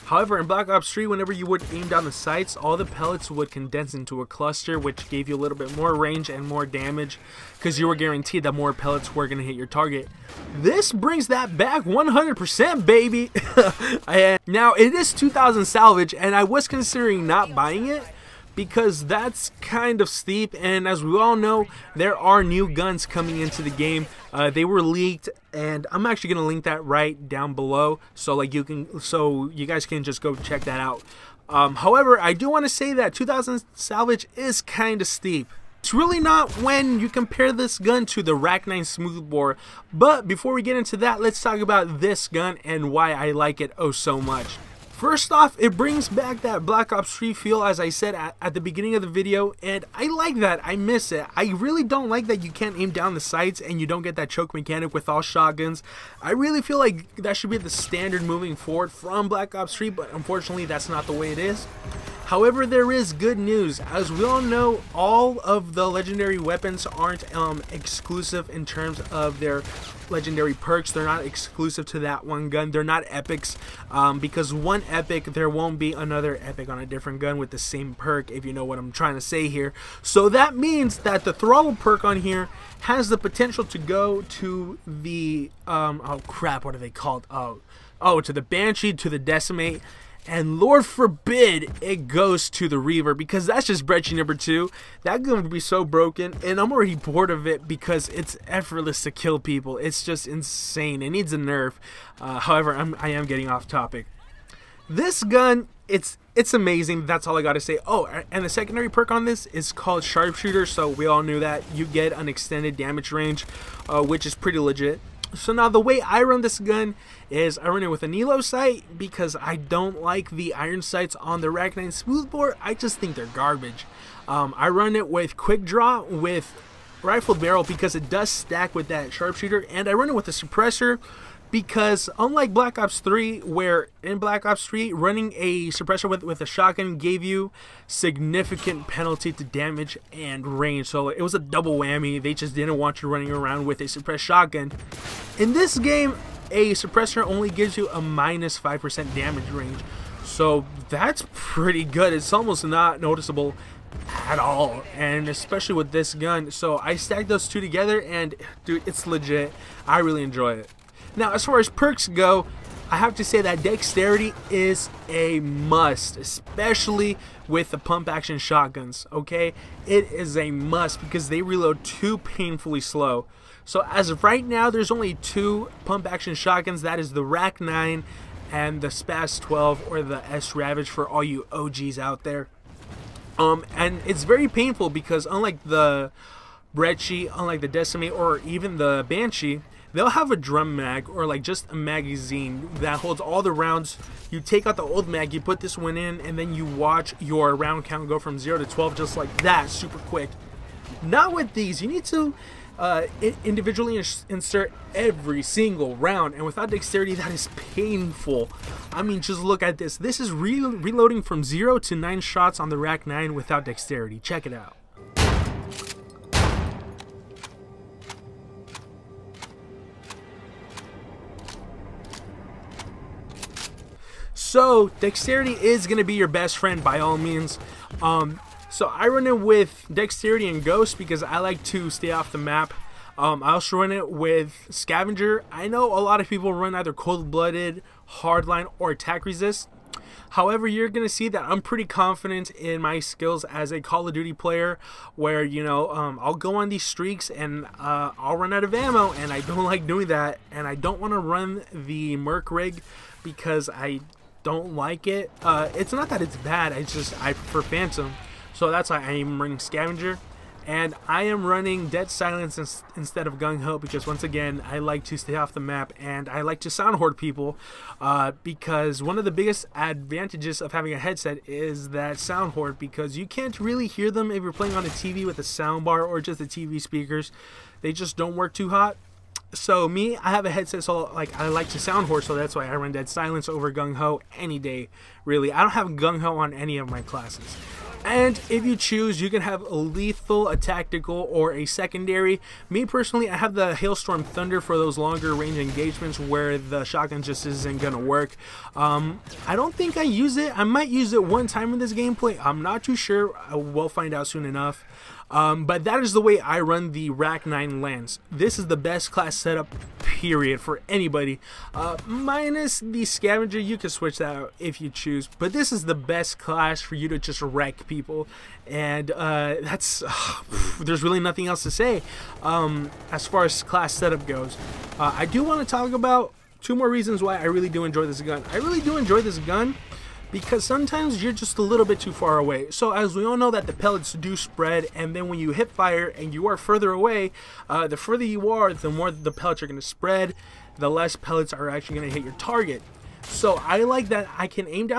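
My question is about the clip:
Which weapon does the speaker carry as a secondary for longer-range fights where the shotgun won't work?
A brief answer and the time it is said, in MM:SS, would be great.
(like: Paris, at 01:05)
Hailstorm Thunder, at 04:53.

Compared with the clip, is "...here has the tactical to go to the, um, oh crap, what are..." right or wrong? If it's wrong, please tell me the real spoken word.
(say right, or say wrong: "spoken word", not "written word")
wrong: "potential", not "tactical".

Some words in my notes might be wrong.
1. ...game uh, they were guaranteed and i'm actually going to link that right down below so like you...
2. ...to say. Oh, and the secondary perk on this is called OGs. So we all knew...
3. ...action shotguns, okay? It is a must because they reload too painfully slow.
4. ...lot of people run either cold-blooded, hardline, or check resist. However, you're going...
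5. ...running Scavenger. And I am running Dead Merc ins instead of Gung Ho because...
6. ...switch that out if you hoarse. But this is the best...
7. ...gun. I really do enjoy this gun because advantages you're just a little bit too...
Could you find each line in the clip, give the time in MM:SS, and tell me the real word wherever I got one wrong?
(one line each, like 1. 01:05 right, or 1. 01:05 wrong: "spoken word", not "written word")
1. 00:23 wrong: "leaked", not "guaranteed"
2. 01:47 wrong: "Sharpshooter", not "OGs"
3. 02:48 right
4. 03:56 wrong: "attack", not "check"
5. 04:19 wrong: "Silence", not "Merc"
6. 05:13 wrong: "choose", not "hoarse"
7. 05:28 wrong: "sometimes", not "advantages".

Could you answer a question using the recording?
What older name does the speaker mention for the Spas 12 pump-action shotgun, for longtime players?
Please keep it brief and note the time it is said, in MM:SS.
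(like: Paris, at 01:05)
S Ravage, at 03:00.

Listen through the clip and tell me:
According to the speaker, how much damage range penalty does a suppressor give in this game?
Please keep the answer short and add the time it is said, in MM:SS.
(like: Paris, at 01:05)
minus 5%, at 02:28.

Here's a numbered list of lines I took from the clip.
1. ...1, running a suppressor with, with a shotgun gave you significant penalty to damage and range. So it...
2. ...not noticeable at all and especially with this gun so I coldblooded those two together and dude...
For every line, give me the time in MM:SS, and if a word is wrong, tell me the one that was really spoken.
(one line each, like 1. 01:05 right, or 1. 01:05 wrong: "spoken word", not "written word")
1. 02:14 wrong: "3", not "1"
2. 02:32 wrong: "stacked", not "coldblooded".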